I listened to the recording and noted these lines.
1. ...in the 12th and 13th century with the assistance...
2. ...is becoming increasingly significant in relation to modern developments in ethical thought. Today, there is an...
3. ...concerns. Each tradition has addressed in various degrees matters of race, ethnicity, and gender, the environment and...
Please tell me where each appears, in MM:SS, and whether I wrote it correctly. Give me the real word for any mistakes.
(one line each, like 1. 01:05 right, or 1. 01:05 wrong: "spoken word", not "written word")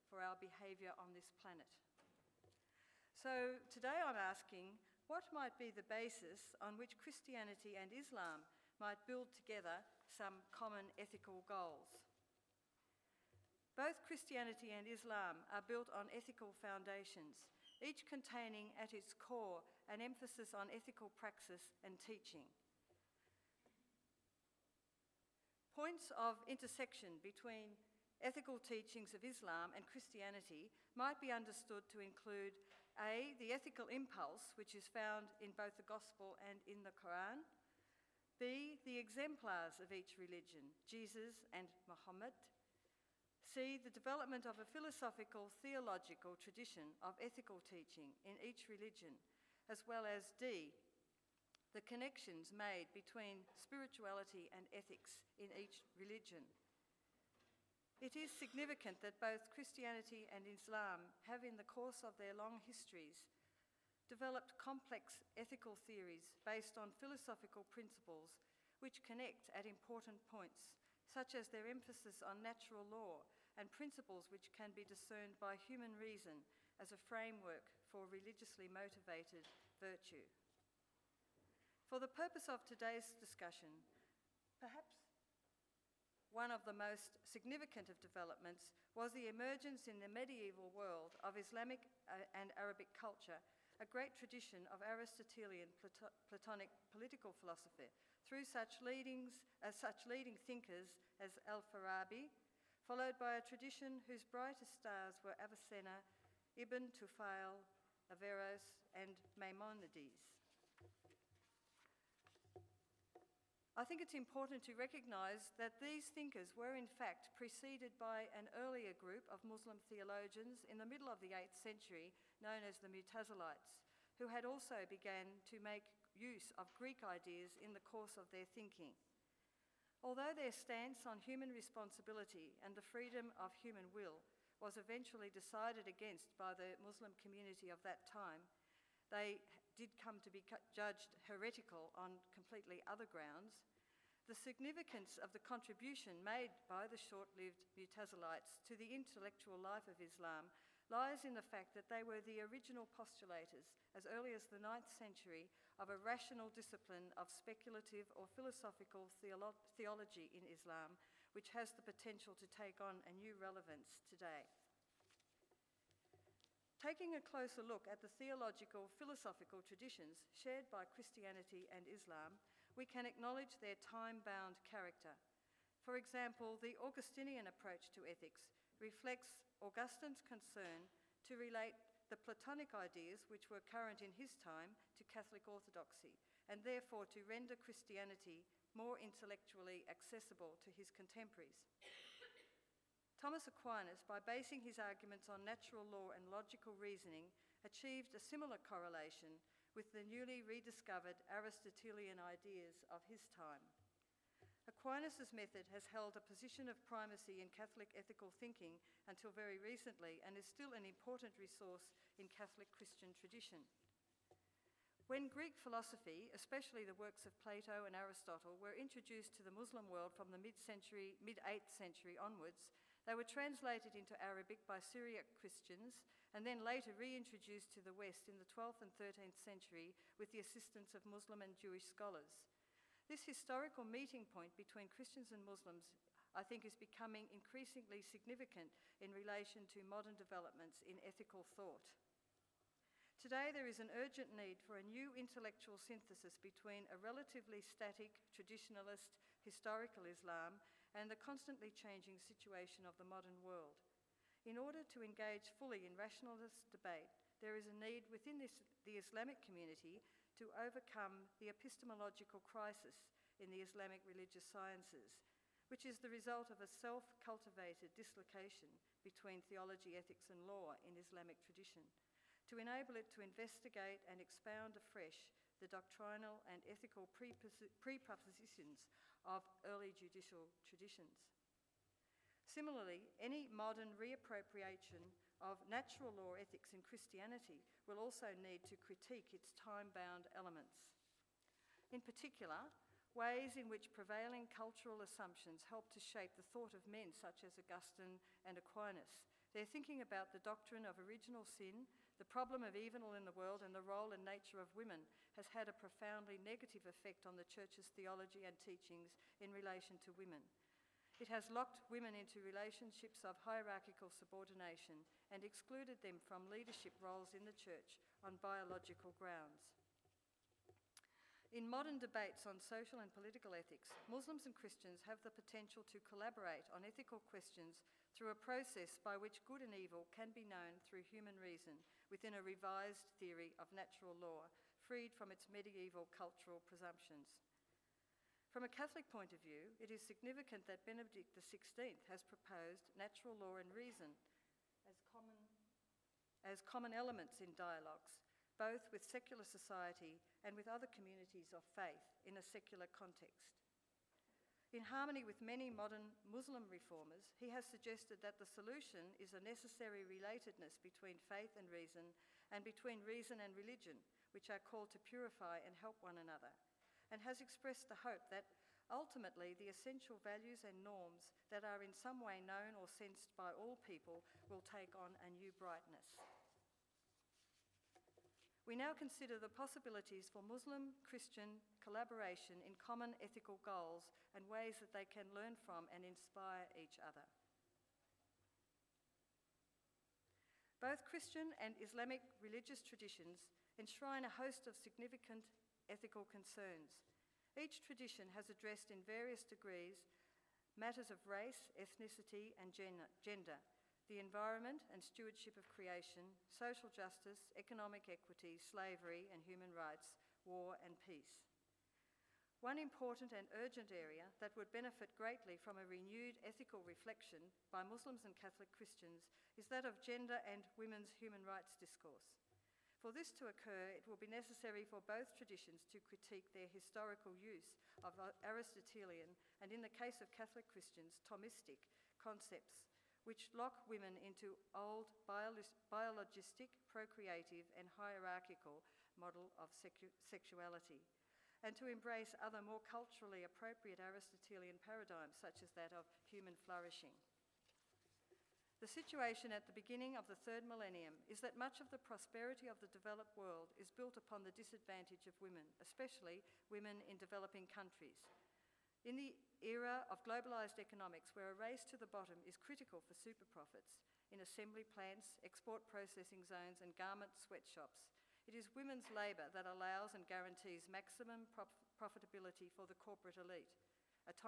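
1. 03:48 right
2. 03:56 right
3. 06:36 right.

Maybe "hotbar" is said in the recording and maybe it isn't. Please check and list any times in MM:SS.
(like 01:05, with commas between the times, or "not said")
not said.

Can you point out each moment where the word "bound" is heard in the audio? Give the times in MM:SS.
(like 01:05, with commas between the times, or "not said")
02:54, 04:49.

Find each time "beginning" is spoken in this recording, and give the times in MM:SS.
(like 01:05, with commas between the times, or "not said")
07:29.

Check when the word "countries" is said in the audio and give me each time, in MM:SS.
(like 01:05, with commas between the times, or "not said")
07:37.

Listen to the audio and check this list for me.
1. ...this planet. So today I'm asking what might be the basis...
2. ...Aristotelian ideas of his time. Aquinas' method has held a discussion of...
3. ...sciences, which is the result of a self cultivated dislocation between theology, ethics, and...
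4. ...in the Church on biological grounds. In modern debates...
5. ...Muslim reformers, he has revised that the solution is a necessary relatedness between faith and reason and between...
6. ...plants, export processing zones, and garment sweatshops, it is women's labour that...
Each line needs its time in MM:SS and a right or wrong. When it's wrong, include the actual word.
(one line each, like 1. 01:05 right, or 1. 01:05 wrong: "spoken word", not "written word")
1. 00:01 right
2. 03:21 wrong: "position", not "discussion"
3. 04:24 right
4. 05:17 right
5. 05:56 wrong: "suggested", not "revised"
6. 07:44 right.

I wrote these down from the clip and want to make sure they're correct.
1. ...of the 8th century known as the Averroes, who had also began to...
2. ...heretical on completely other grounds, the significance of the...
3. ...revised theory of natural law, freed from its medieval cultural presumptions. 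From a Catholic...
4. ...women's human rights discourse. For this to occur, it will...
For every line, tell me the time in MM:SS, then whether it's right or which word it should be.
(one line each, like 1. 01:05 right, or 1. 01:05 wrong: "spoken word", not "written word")
1. 02:01 wrong: "Mutazilites", not "Averroes"
2. 02:21 right
3. 05:32 right
4. 07:00 right.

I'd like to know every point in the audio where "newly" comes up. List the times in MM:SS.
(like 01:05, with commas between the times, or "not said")
03:20.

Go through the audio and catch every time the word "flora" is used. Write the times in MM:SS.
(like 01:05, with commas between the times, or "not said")
not said.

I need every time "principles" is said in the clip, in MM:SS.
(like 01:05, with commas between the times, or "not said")
01:07, 01:13.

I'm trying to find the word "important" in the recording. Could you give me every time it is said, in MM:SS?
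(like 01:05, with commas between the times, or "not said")
01:09, 01:54, 03:30, 06:52.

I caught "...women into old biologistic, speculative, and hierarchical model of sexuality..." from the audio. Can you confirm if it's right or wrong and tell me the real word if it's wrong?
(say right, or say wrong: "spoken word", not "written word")
wrong: "procreative", not "speculative".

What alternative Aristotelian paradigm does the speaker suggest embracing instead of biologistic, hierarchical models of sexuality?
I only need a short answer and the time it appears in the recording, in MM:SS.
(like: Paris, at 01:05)
human flourishing, at 07:26.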